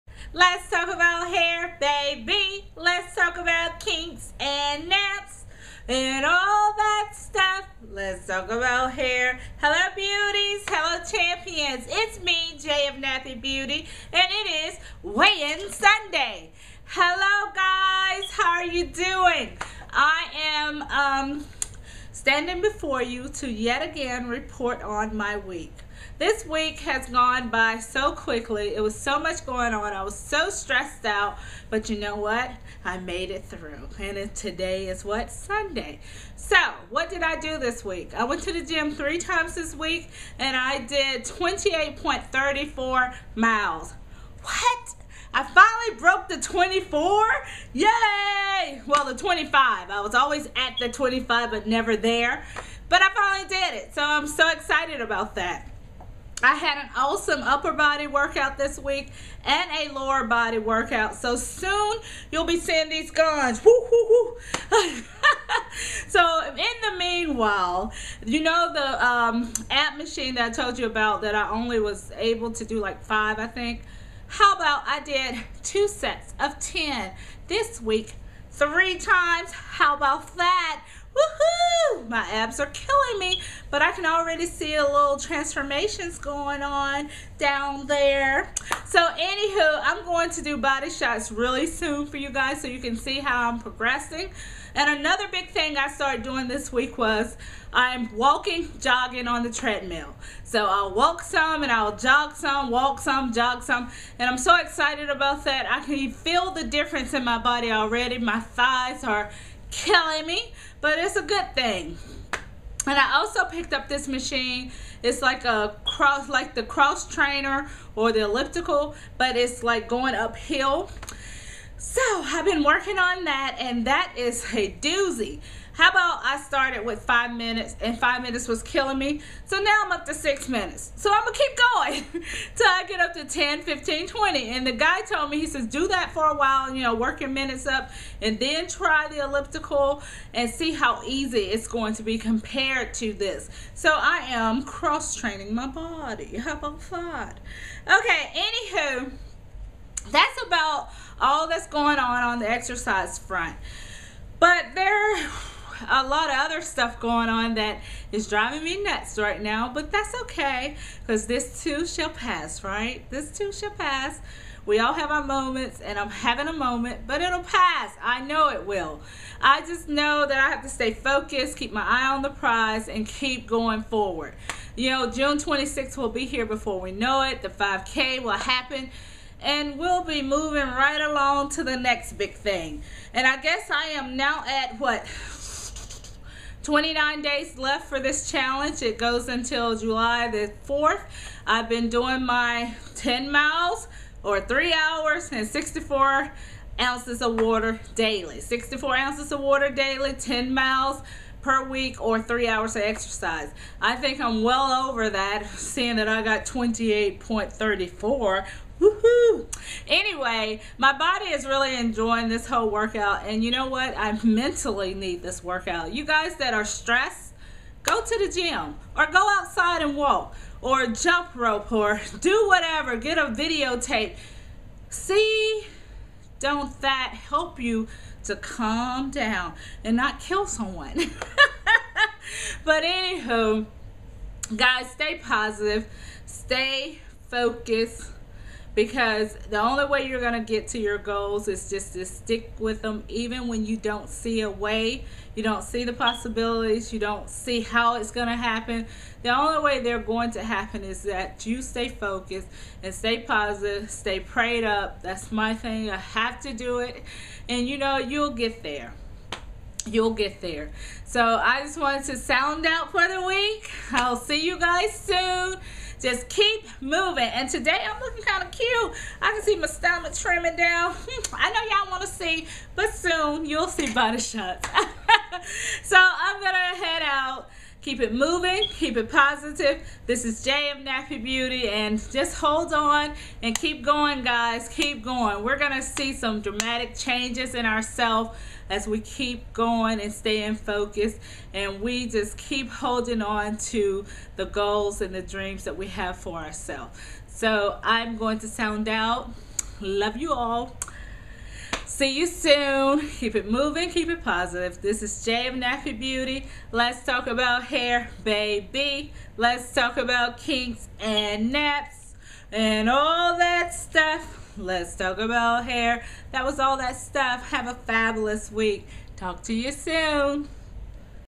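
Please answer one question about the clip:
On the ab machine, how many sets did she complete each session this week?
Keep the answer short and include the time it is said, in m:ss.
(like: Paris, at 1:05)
2 sets of 10, at 1:15.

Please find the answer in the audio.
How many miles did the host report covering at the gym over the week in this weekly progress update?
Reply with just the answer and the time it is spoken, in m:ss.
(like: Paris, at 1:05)
28.34, at 0:41.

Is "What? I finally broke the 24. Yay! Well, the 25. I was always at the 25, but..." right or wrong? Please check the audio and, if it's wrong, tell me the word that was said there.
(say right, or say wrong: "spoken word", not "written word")
right.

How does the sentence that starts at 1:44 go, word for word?
And I'm so excited about that.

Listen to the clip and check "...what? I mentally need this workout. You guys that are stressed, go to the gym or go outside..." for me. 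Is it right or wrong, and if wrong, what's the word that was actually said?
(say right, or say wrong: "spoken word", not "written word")
right.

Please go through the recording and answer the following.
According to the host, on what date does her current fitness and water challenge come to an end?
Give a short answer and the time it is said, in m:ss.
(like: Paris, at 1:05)
July 4th, at 3:09.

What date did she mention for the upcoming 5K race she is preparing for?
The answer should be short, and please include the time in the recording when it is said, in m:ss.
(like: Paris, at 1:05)
June 26th, at 2:55.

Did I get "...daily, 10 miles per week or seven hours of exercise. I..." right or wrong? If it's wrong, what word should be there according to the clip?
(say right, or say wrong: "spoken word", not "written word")
wrong: "three", not "seven".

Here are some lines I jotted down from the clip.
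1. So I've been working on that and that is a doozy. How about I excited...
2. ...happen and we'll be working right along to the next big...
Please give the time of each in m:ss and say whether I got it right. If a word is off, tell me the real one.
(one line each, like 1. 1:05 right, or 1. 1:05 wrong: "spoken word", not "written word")
1. 2:01 wrong: "started", not "excited"
2. 2:58 wrong: "moving", not "working".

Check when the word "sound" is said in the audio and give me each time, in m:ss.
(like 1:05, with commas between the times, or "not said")
4:22, 4:58.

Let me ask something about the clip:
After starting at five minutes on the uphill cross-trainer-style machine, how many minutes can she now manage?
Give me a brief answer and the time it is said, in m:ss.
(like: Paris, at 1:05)
6 minutes, at 2:10.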